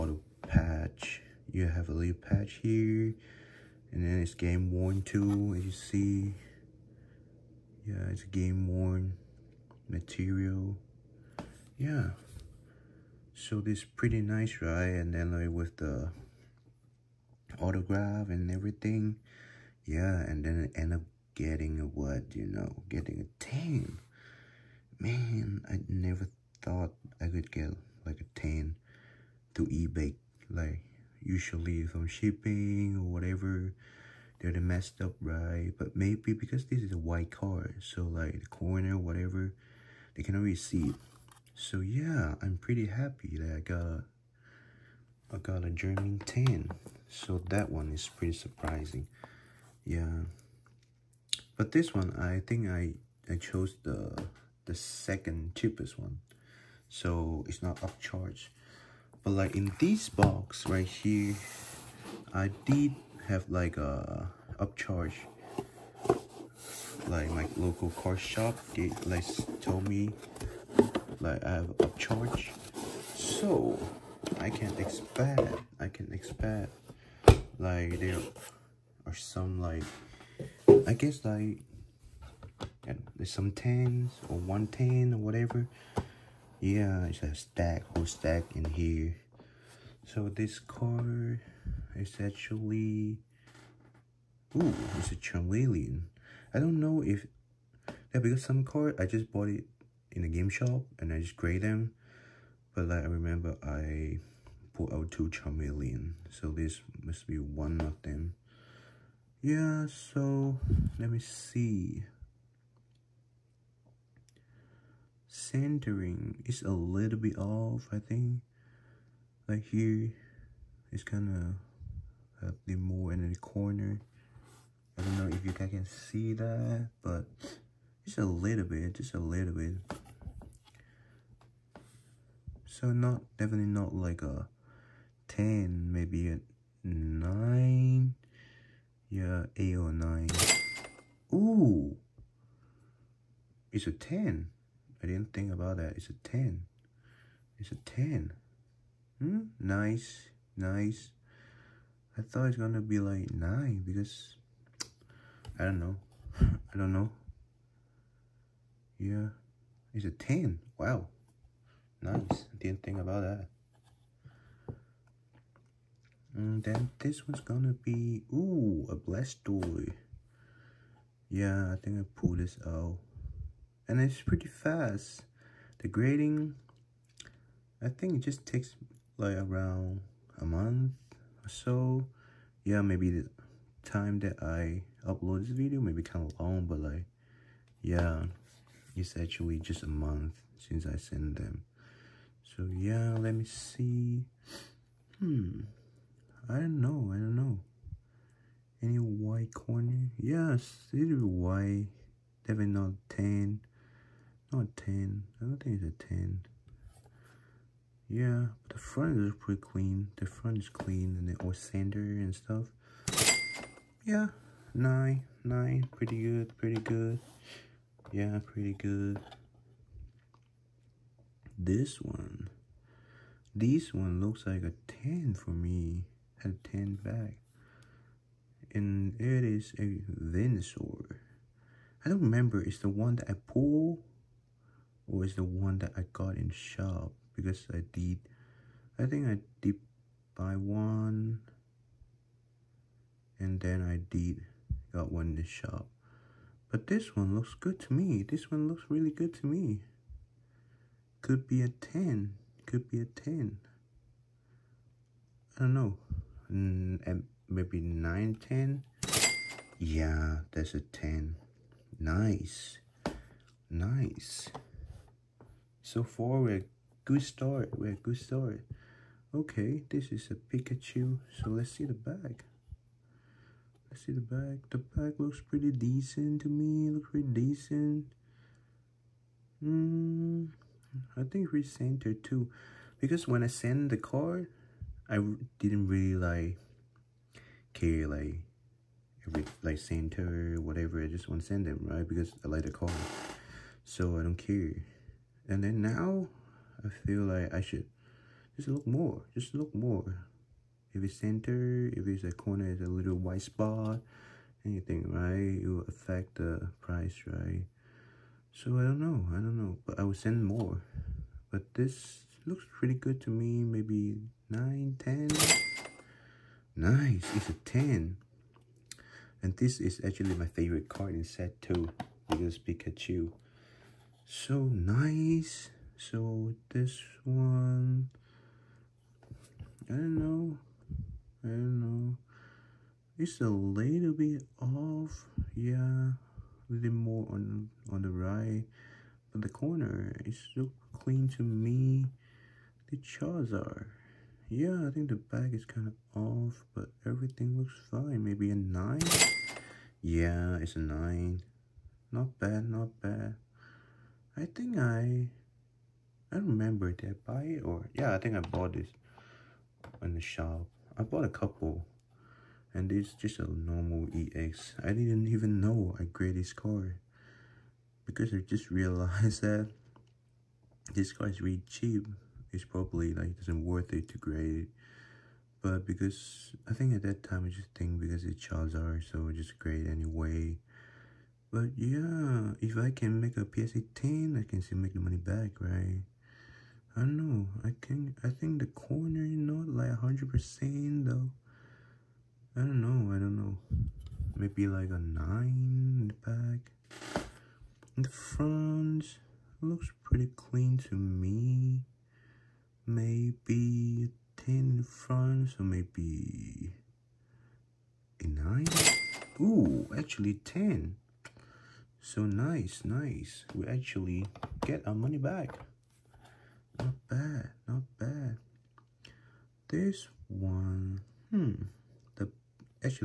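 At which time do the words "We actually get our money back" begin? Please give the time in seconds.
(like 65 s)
413 s.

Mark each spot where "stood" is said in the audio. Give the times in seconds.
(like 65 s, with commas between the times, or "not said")
not said.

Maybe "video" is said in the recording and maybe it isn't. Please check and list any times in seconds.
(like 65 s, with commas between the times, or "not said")
185 s.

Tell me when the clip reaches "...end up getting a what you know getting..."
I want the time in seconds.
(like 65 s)
20 s.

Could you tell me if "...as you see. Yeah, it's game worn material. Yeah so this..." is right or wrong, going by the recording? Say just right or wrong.
right.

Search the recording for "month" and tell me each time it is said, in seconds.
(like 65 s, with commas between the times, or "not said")
180 s, 189 s.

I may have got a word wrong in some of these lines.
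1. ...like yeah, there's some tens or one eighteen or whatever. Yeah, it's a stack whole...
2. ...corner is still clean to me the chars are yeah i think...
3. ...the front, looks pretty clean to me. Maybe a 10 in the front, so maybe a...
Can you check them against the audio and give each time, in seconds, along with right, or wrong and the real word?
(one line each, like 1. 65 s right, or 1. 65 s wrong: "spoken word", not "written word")
1. 81 s wrong: "ten", not "eighteen"
2. 339 s right
3. 398 s right.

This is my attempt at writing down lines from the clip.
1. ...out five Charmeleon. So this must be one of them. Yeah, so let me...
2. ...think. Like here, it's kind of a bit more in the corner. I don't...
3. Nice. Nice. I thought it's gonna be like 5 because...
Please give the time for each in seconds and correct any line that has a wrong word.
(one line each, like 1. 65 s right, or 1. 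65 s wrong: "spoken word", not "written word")
1. 104 s wrong: "two", not "five"
2. 117 s right
3. 149 s wrong: "9", not "5".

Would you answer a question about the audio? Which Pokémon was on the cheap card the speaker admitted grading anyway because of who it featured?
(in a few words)
Charizard.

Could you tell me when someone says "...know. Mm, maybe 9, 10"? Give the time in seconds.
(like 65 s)
255 s.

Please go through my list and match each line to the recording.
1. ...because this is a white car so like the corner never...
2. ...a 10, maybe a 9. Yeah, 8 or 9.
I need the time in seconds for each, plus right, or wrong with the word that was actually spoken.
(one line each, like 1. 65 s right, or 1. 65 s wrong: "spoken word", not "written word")
1. 36 s wrong: "whatever", not "never"
2. 134 s right.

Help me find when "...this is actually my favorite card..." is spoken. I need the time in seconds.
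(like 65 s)
319 s.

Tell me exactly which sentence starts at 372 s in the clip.
It's probably like it does isn't worth it to grade it.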